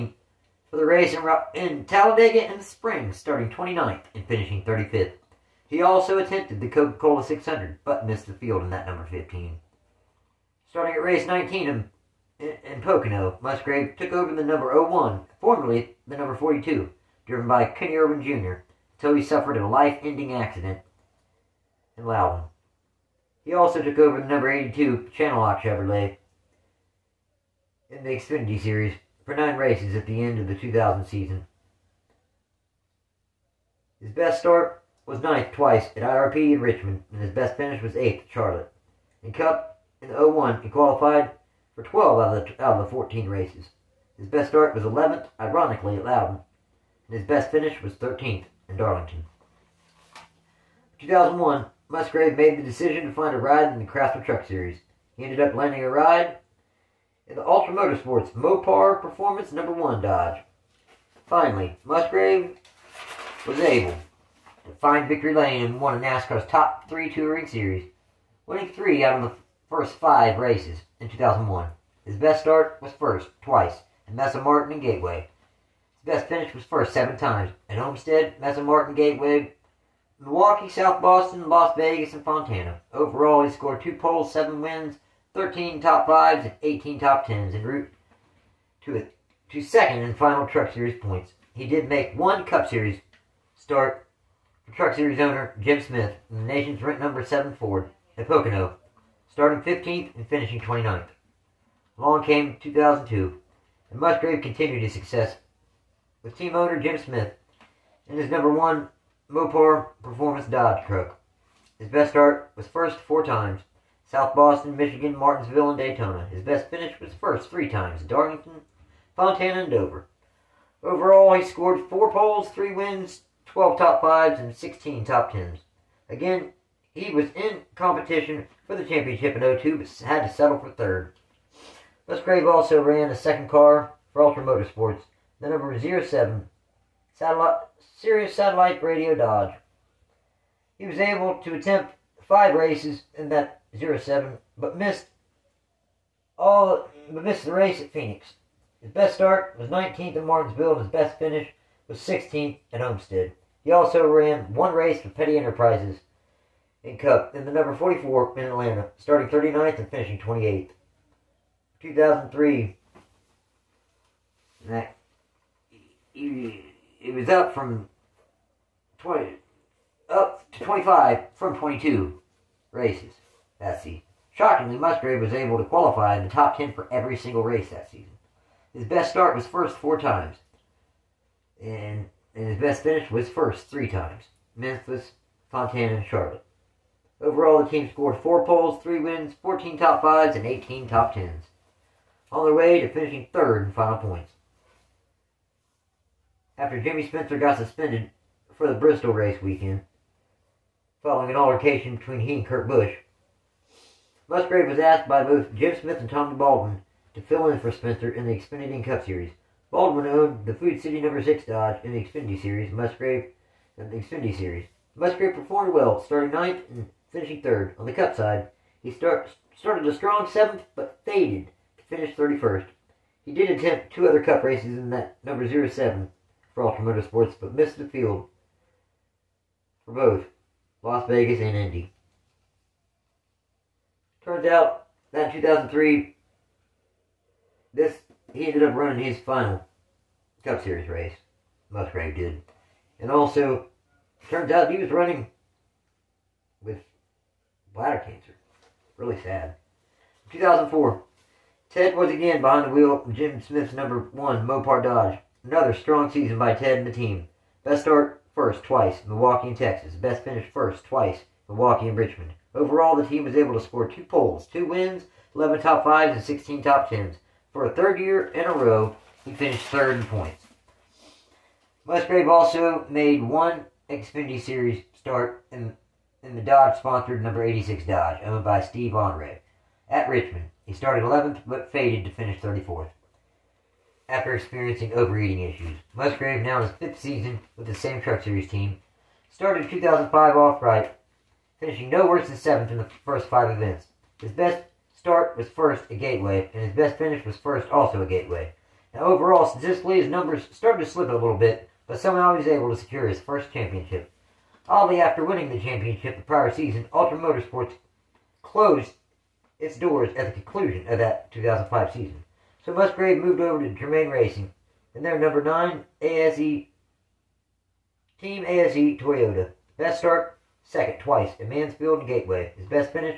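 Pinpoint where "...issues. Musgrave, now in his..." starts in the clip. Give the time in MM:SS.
04:45.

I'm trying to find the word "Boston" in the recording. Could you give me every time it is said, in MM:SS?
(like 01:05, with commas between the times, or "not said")
01:21, 01:54.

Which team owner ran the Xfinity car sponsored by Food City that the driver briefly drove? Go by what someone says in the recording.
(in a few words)
Tommy Baldwin.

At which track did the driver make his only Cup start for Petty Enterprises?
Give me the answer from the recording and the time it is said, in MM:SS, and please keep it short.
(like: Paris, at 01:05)
Atlanta, at 02:38.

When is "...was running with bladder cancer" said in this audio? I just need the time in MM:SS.
04:04.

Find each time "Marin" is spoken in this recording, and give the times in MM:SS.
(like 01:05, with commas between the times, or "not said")
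01:14, 01:18.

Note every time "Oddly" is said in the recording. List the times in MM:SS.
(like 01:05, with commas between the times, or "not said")
05:04.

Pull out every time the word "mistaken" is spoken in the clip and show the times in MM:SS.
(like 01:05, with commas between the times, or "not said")
not said.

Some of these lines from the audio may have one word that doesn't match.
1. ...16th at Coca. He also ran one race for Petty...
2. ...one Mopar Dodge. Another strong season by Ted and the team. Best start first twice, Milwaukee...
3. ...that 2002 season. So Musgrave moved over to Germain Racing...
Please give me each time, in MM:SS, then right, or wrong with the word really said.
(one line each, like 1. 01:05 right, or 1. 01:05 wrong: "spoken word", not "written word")
1. 02:31 wrong: "Homestead", not "Coca"
2. 04:14 right
3. 05:10 wrong: "2005", not "2002".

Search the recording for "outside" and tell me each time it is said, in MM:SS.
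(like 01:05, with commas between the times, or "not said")
not said.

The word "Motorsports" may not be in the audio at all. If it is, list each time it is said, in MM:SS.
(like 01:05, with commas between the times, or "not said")
00:57, 02:14, 03:46, 05:07.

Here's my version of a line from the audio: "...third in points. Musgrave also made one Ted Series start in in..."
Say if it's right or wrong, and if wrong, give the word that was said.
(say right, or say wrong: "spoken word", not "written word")
wrong: "Xfinity", not "Ted".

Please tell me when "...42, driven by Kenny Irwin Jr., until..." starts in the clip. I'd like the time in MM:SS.
00:16.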